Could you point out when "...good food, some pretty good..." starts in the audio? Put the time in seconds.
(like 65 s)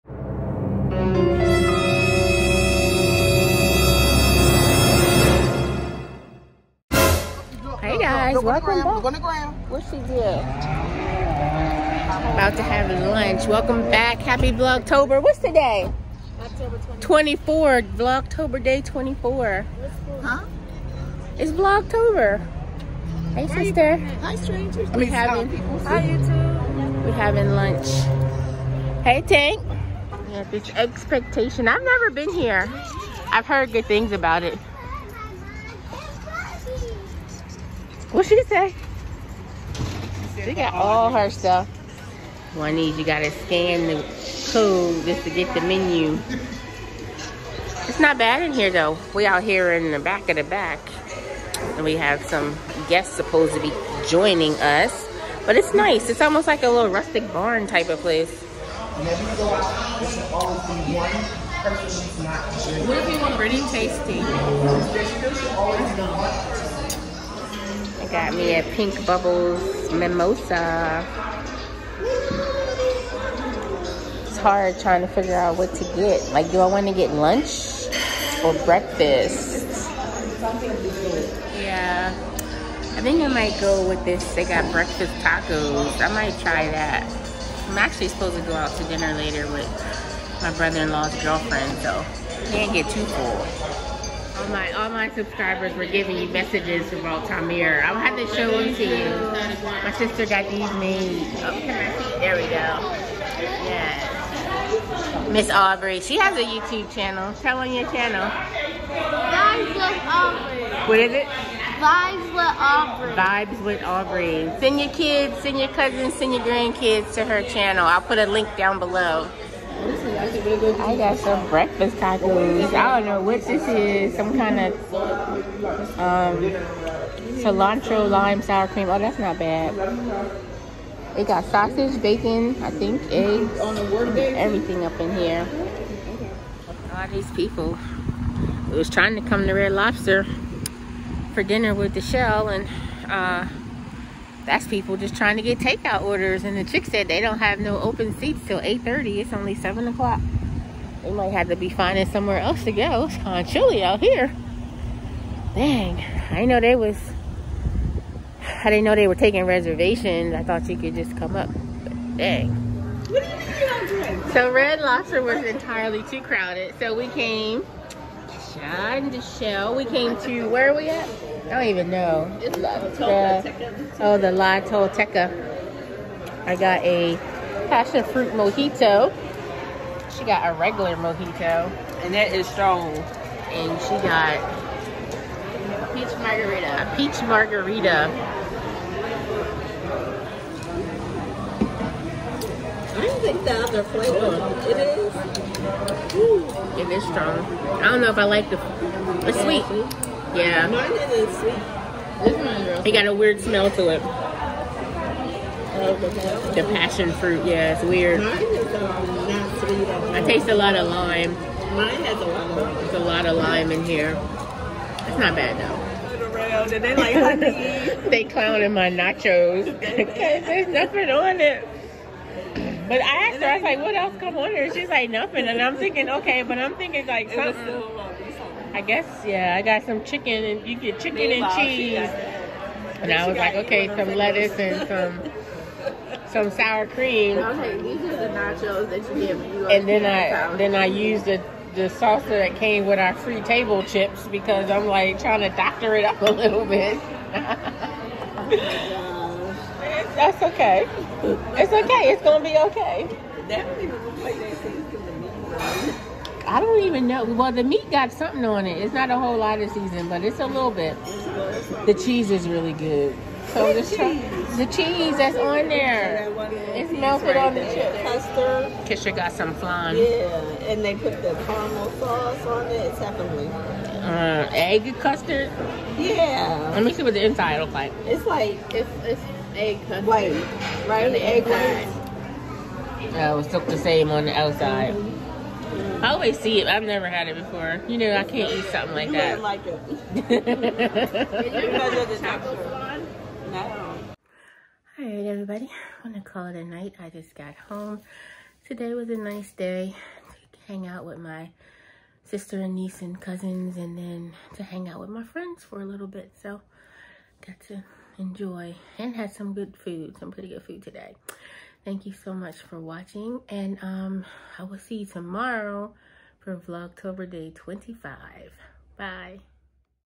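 309 s.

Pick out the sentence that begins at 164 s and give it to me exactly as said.
So Red Lobster was entirely too crowded.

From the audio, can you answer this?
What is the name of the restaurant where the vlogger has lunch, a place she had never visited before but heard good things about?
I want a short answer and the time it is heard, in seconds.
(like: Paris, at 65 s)
Eggspectation, at 30 s.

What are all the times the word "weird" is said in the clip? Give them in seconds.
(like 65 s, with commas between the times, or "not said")
203 s, 207 s.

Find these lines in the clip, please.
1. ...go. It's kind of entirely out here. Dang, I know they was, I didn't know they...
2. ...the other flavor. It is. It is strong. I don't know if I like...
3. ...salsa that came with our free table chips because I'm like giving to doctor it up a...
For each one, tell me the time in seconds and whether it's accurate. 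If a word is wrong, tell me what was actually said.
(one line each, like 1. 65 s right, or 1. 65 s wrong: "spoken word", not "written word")
1. 152 s wrong: "chilly", not "entirely"
2. 193 s right
3. 241 s wrong: "trying", not "giving".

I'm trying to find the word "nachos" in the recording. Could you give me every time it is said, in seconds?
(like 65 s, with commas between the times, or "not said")
218 s, 238 s.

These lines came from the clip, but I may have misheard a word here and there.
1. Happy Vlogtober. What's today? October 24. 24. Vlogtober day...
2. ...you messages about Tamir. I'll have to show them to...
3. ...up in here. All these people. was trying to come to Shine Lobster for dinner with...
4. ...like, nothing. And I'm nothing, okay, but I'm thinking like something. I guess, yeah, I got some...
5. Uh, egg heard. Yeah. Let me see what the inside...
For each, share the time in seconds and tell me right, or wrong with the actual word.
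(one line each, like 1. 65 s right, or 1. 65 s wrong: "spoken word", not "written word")
1. 14 s right
2. 96 s right
3. 134 s wrong: "Red", not "Shine"
4. 224 s wrong: "thinking", not "nothing"
5. 274 s wrong: "custard", not "heard".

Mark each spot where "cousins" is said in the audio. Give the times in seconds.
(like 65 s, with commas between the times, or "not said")
115 s, 303 s.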